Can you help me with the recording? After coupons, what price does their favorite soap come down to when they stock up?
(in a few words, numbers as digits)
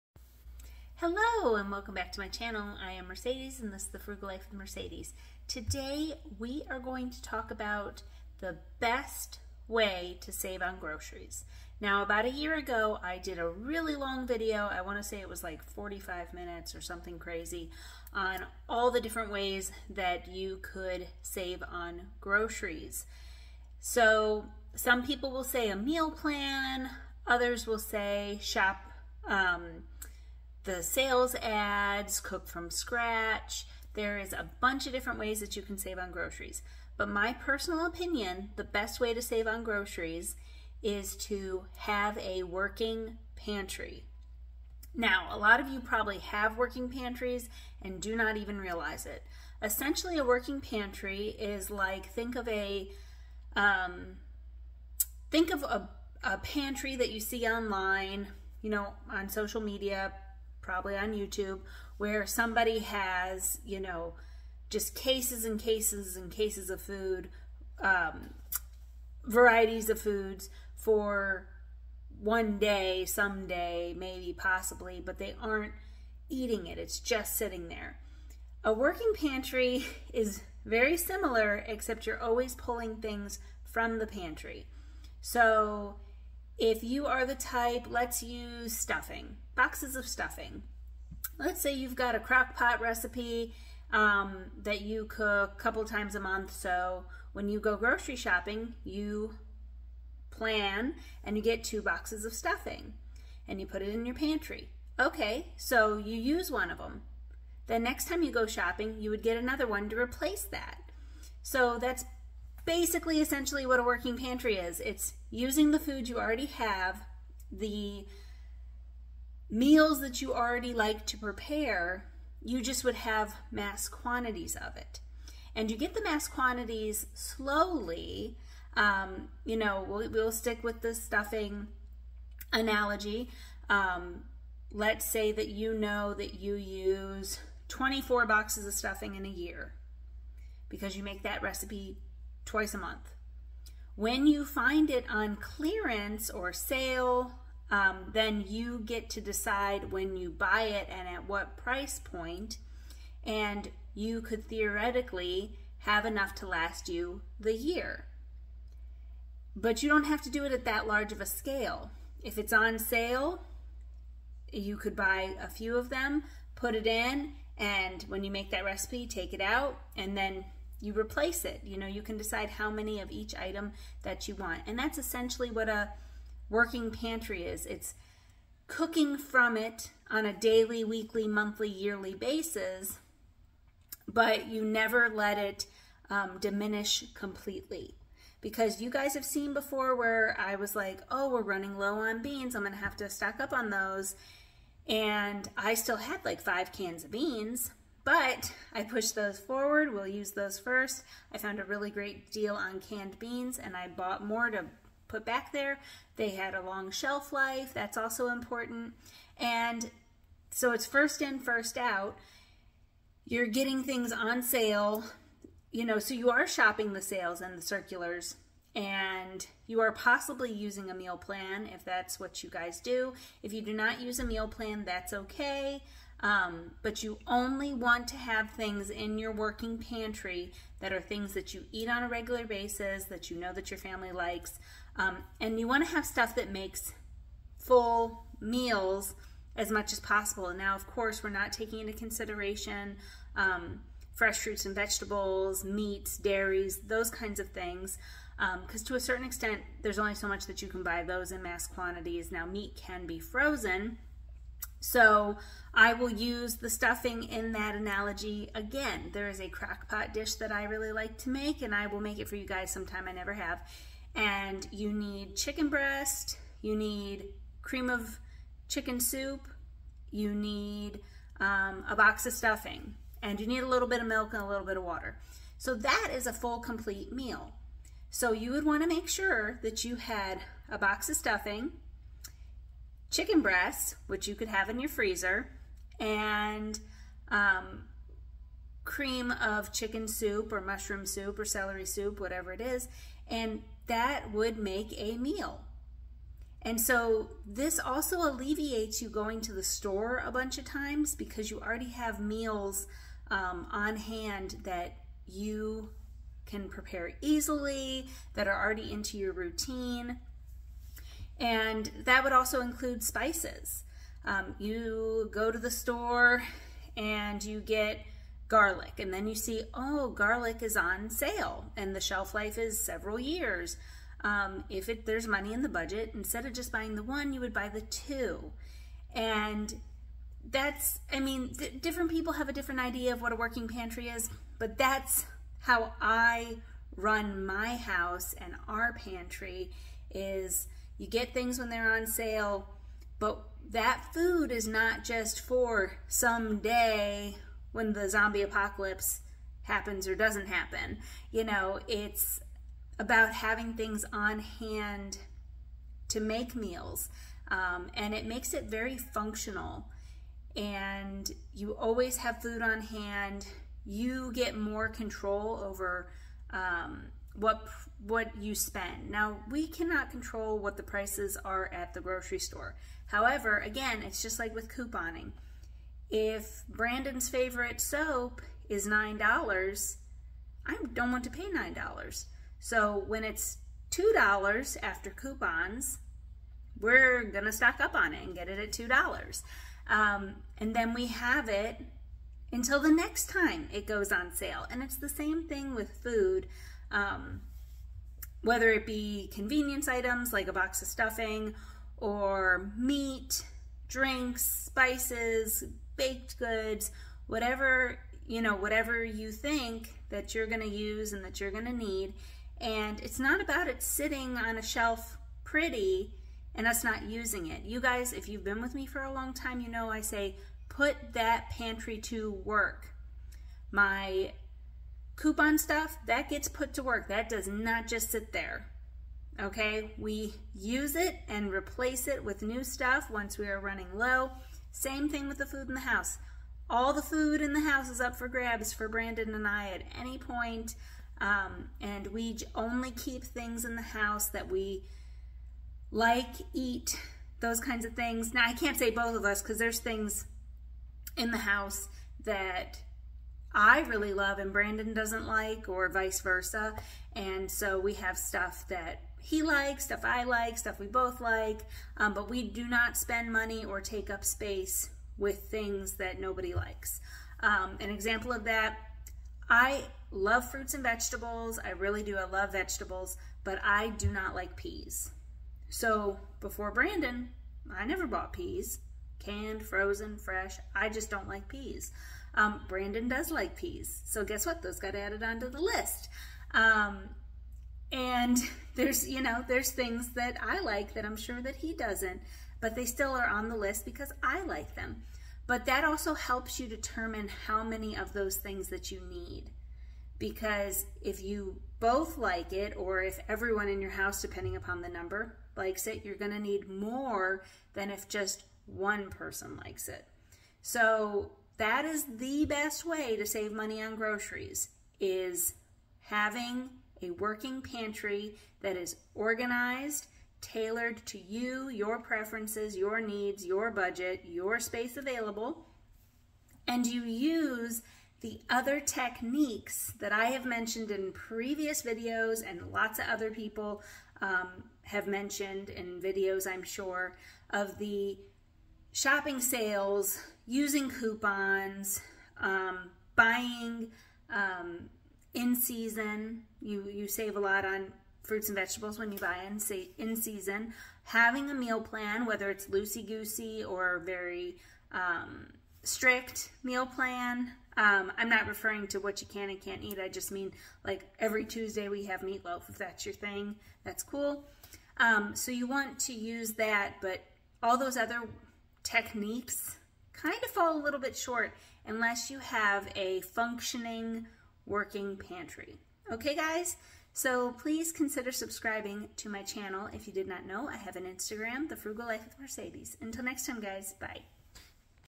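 $2.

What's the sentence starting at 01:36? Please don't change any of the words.
So when you go grocery shopping, you plan and you get two boxes of stuffing and you put it in your pantry.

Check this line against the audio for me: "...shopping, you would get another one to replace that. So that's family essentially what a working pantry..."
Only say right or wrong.
wrong.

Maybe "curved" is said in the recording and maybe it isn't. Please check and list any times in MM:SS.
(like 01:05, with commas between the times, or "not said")
not said.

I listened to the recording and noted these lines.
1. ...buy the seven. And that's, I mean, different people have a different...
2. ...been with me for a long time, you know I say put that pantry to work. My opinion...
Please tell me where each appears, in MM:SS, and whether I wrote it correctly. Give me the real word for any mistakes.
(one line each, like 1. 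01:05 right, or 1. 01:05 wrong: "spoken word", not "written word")
1. 05:27 wrong: "two", not "seven"
2. 06:58 wrong: "coupon", not "opinion".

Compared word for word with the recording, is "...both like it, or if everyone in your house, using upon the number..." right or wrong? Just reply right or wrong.
wrong.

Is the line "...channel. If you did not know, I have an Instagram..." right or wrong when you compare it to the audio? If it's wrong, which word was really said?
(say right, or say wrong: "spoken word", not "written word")
right.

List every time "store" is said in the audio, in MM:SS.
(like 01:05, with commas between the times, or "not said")
04:59, 05:15, 06:12.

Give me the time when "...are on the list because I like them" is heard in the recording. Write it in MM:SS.
08:13.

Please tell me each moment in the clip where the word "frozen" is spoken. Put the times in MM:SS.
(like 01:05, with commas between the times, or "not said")
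04:13, 07:59.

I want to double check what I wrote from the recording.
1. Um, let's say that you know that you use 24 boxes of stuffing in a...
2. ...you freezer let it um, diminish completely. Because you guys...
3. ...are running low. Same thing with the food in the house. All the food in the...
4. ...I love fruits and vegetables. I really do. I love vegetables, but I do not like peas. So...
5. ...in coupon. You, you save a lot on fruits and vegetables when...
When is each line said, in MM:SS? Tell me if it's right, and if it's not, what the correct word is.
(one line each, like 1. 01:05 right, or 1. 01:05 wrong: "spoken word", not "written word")
1. 02:13 right
2. 03:04 wrong: "never", not "freezer"
3. 07:13 right
4. 07:49 right
5. 09:05 wrong: "season", not "coupon".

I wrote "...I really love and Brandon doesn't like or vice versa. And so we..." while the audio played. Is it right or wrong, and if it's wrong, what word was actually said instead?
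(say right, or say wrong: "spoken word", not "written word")
right.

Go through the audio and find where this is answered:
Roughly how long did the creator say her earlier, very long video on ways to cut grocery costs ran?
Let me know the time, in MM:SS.
00:15.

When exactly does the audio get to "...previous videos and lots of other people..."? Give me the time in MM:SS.
08:51.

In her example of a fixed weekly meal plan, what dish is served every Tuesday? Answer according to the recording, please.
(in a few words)
meatloaf.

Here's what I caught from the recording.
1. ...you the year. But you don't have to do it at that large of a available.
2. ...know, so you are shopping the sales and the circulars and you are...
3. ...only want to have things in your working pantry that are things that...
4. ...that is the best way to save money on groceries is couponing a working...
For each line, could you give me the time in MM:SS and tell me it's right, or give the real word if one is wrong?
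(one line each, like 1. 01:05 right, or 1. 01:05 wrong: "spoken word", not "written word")
1. 02:36 wrong: "scale", not "available"
2. 03:35 right
3. 03:47 right
4. 08:31 wrong: "having", not "couponing".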